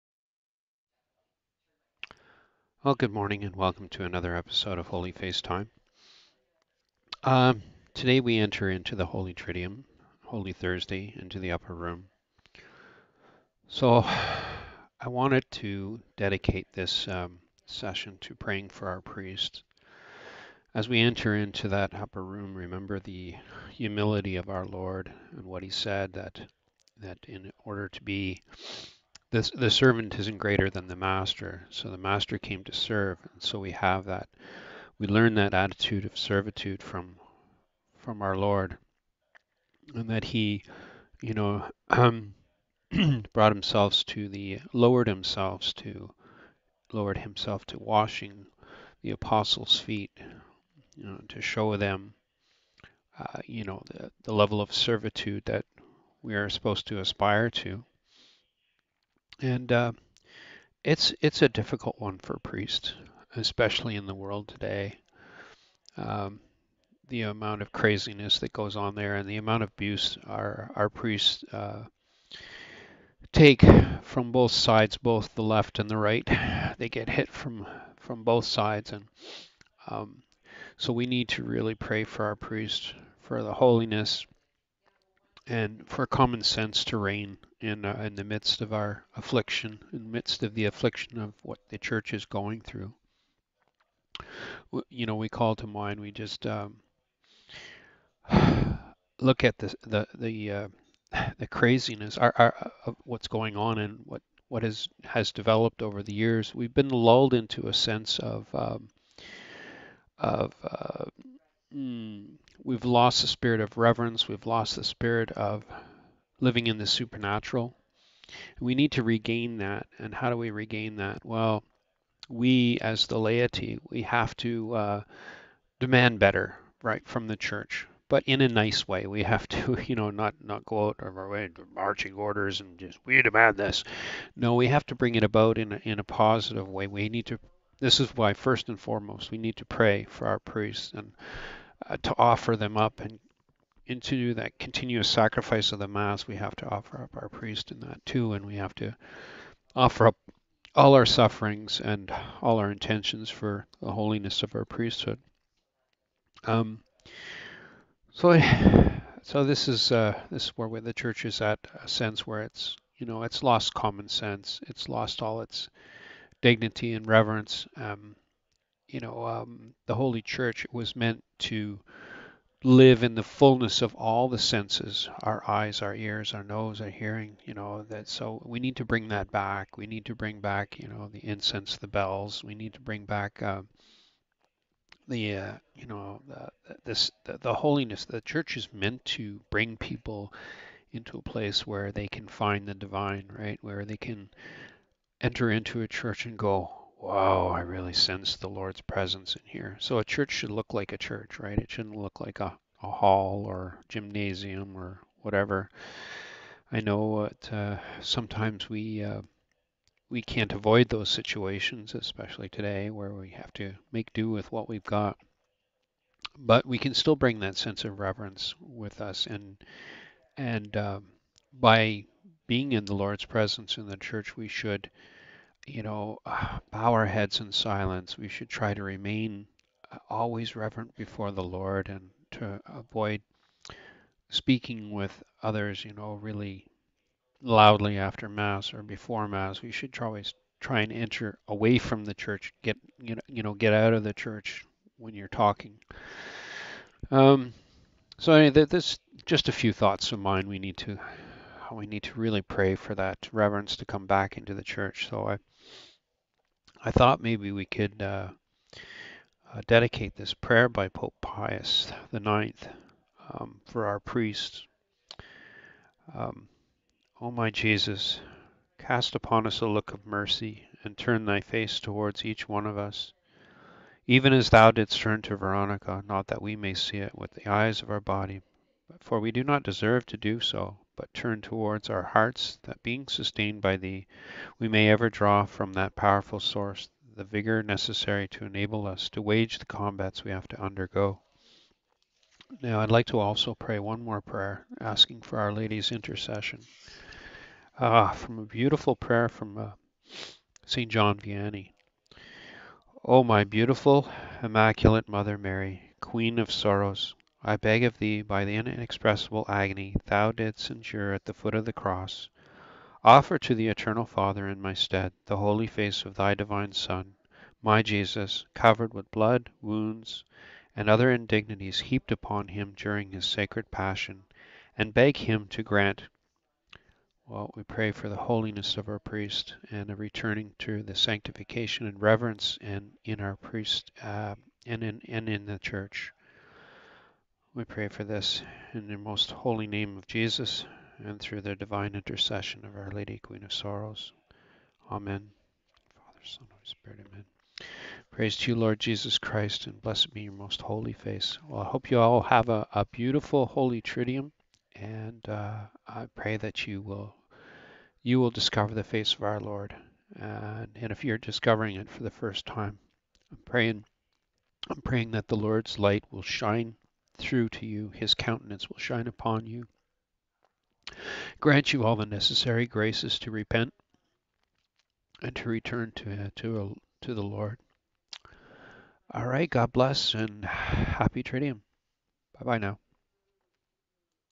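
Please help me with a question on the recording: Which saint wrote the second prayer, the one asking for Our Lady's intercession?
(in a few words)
St. John Vianney.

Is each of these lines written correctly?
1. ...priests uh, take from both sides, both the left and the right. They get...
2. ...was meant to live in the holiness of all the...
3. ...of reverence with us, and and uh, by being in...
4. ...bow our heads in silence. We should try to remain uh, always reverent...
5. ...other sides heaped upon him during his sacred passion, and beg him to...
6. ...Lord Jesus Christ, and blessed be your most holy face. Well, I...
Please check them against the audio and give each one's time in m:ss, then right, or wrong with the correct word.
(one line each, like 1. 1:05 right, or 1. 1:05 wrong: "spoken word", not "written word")
1. 1:10 right
2. 2:50 wrong: "fullness", not "holiness"
3. 3:37 right
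4. 3:46 right
5. 5:20 wrong: "indignities", not "sides"
6. 5:48 right.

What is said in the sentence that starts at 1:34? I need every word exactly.
You know, we call to mind.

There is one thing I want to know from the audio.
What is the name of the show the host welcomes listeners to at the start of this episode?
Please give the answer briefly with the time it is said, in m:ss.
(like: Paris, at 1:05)
Holy Face Time, at 0:04.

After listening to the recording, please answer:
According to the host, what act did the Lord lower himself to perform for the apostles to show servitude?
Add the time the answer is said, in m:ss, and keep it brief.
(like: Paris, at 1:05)
washing the apostles feet, at 0:47.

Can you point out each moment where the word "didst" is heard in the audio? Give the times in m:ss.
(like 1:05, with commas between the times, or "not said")
4:34, 5:10.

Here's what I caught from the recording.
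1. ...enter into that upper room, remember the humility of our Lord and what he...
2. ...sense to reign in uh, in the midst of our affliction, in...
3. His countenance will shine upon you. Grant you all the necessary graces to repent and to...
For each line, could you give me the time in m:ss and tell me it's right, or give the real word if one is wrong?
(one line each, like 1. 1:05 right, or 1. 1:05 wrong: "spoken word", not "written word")
1. 0:21 right
2. 1:26 right
3. 6:07 right.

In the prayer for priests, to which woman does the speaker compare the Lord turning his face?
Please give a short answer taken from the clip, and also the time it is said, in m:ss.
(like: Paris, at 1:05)
Veronica, at 4:35.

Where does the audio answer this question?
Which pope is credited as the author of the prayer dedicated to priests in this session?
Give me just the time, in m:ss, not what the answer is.
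4:20.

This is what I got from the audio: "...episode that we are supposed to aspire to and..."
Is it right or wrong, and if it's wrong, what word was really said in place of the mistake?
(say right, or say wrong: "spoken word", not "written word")
wrong: "servitude", not "episode".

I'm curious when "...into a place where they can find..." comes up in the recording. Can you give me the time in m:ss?
3:10.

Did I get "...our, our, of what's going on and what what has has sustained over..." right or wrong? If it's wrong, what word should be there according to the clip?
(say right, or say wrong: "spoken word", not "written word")
wrong: "developed", not "sustained".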